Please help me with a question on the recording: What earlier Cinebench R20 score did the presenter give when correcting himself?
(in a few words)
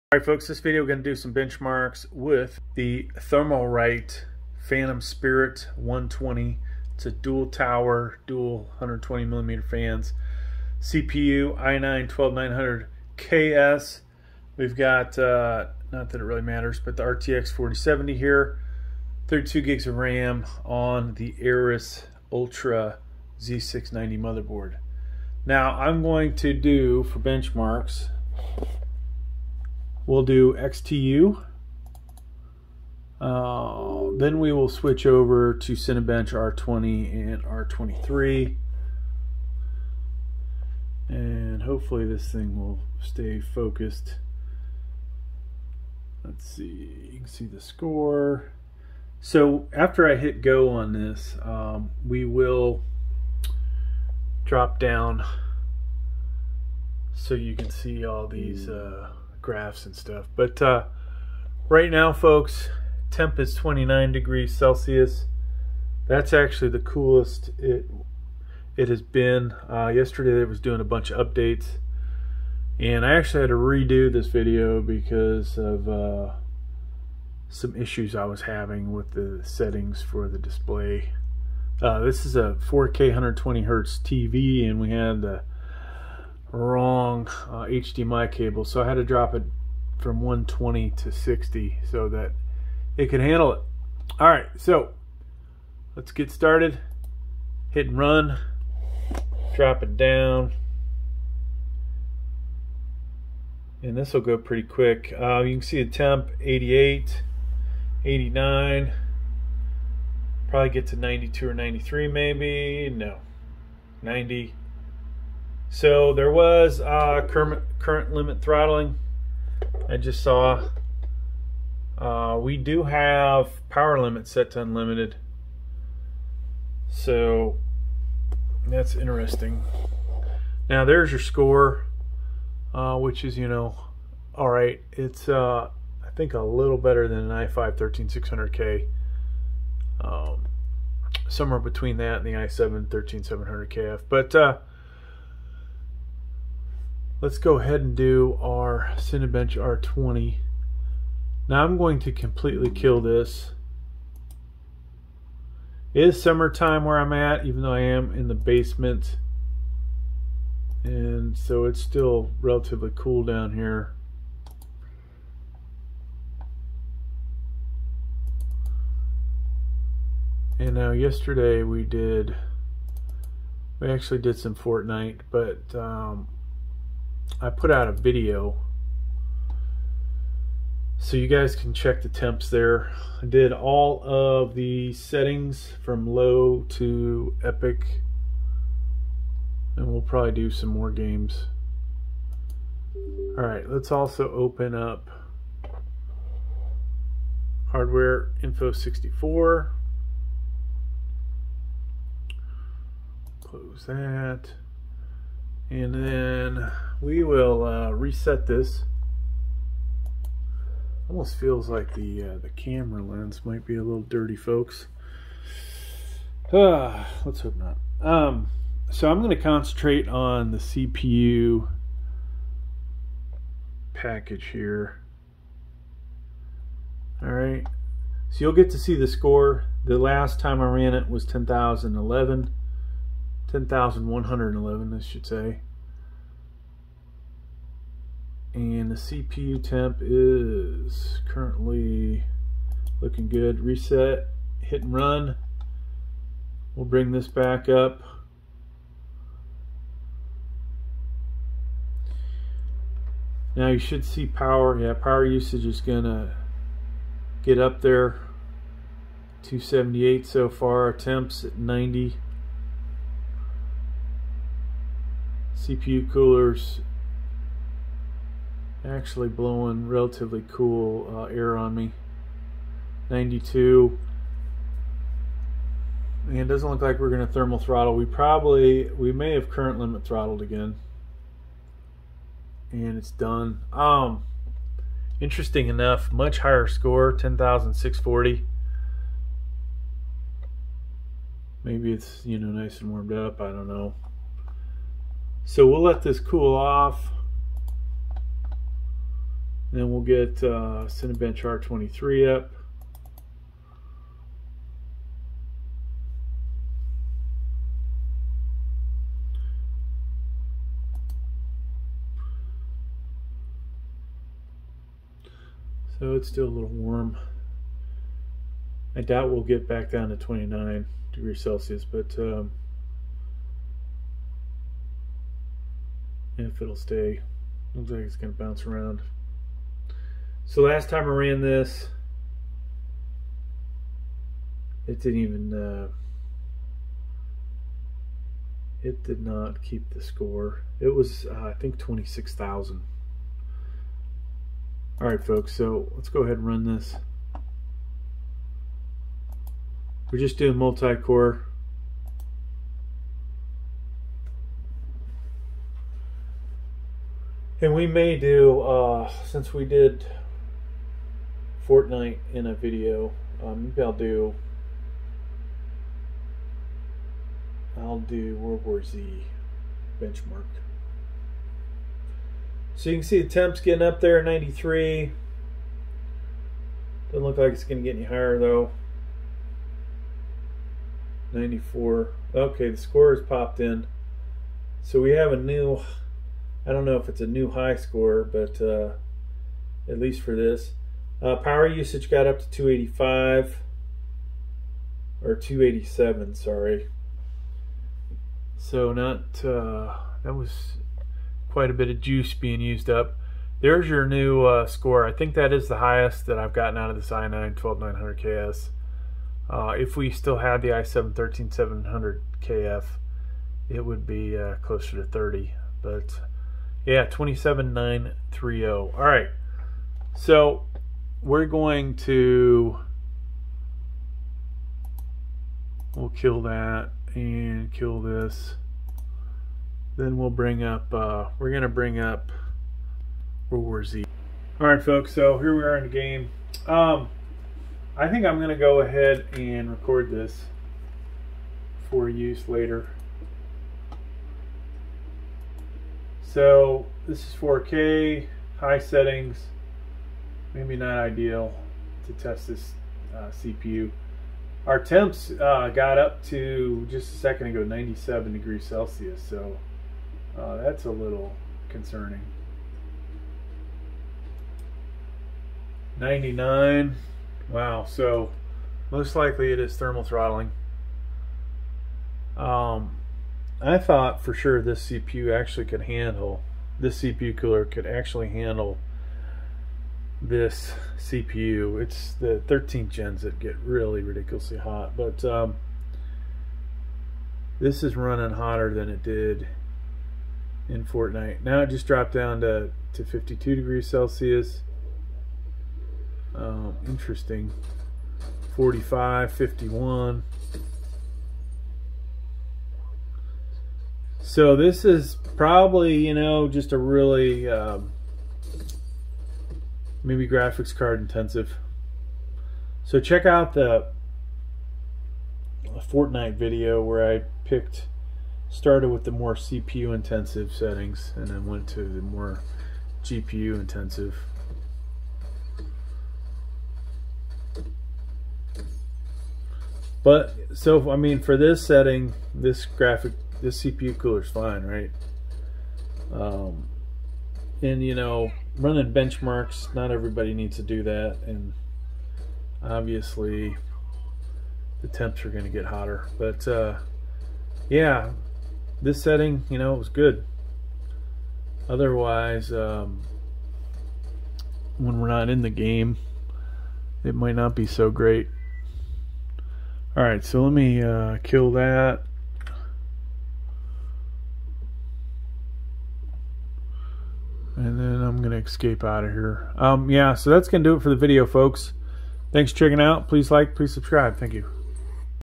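10,111.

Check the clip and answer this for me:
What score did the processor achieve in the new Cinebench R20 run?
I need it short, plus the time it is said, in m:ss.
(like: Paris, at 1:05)
10,640, at 4:47.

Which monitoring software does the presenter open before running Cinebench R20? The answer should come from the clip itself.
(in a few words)
Hardware Info 64.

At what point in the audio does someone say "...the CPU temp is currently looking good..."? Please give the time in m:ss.
3:58.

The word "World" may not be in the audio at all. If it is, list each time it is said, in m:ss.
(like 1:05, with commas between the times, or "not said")
6:08, 7:13.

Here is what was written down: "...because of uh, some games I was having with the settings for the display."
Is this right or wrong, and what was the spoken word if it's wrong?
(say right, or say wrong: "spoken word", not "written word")
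wrong: "issues", not "games".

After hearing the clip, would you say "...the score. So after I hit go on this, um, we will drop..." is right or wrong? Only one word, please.
right.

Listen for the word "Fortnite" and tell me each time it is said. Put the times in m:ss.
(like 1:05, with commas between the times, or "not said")
2:54, 6:01, 8:10, 8:35.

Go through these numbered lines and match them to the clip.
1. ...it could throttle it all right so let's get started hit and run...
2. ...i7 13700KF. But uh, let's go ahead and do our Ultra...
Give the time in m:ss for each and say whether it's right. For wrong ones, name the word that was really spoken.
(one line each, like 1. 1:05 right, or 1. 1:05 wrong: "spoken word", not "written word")
1. 1:32 wrong: "handle", not "throttle"
2. 2:22 wrong: "Cinebench", not "Ultra".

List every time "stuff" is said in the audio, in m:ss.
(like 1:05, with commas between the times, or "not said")
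0:59.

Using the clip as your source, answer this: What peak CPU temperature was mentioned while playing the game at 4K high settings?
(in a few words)
99.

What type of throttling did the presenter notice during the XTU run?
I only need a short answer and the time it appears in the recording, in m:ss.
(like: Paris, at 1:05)
current limit throttling, at 1:57.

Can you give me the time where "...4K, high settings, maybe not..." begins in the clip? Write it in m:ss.
7:27.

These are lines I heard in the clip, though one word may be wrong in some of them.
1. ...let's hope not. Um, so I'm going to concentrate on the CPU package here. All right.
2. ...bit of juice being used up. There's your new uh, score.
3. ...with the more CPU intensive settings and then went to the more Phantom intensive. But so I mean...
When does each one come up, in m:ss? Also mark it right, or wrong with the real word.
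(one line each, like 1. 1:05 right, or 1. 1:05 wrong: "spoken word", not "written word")
1. 3:37 right
2. 6:41 right
3. 8:38 wrong: "GPU", not "Phantom".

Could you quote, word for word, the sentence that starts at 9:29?
Um, yeah, so that's going to do it for the video, folks.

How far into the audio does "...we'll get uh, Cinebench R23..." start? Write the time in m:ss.
4:59.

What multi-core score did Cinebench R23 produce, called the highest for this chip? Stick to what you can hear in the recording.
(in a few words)
27,930.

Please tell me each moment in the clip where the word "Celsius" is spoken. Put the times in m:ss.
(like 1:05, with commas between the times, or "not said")
1:04, 5:21, 7:38, 8:13.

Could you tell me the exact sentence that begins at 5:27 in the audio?
Looks like it's going to bounce around.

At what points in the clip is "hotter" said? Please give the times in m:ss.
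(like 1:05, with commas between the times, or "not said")
8:08, 9:05.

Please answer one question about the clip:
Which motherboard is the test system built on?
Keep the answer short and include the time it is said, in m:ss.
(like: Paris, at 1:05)
Aorus Ultra Z690, at 0:21.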